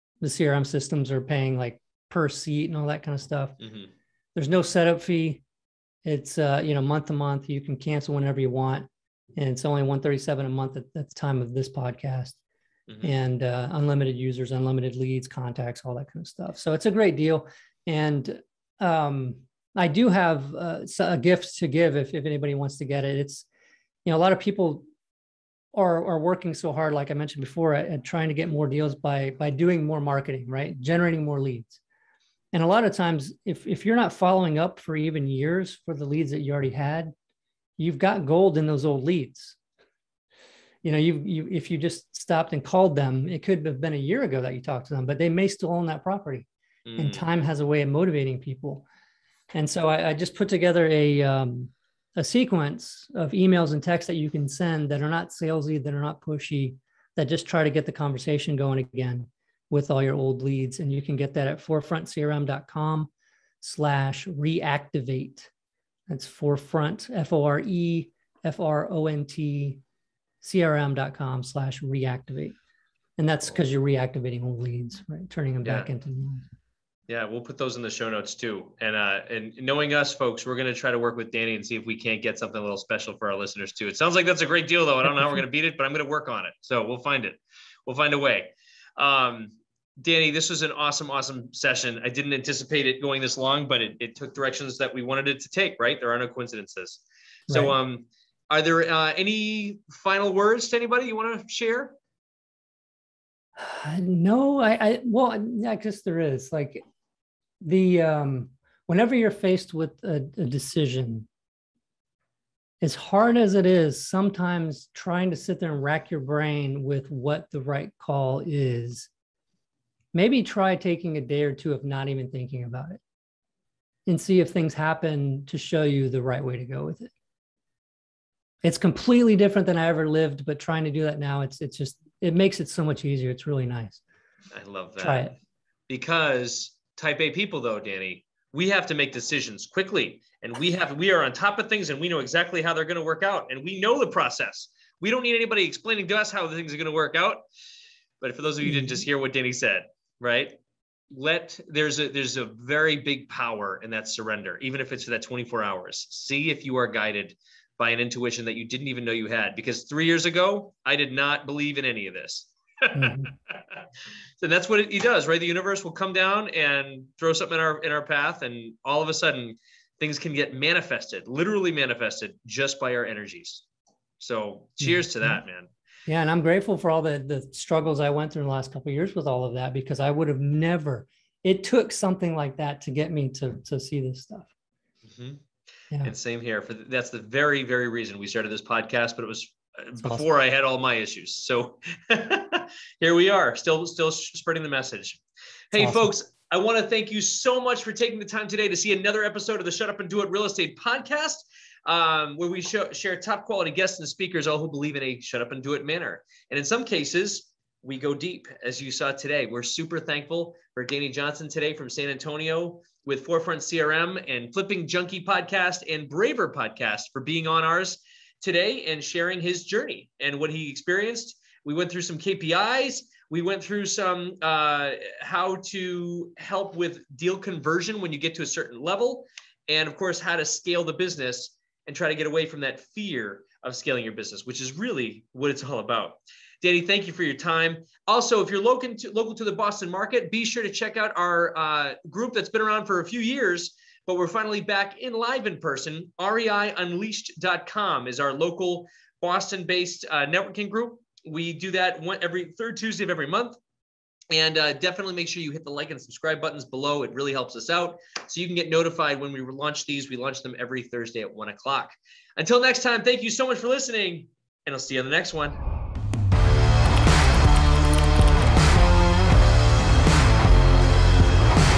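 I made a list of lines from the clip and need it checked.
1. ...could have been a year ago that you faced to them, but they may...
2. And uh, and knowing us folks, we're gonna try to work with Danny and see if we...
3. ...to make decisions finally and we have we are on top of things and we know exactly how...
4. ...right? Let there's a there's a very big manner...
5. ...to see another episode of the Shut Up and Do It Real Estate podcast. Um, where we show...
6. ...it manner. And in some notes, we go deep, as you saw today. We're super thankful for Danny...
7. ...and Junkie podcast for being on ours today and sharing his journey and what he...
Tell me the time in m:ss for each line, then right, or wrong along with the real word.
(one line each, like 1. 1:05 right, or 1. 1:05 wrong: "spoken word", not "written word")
1. 0:43 wrong: "talked", not "faced"
2. 1:18 right
3. 2:18 wrong: "quickly", not "finally"
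4. 2:30 wrong: "power", not "manner"
5. 3:18 right
6. 3:25 wrong: "cases", not "notes"
7. 3:35 wrong: "Braver", not "Junkie".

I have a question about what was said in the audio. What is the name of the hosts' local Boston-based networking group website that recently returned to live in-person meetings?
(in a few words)
REIUnleashed.com.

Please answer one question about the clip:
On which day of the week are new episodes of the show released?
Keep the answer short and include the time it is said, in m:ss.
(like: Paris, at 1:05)
Thursday, at 4:20.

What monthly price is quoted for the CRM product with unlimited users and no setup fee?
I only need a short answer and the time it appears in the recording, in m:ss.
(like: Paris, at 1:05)
137, at 0:09.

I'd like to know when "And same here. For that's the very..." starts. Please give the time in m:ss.
3:06.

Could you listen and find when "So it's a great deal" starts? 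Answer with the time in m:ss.
0:16.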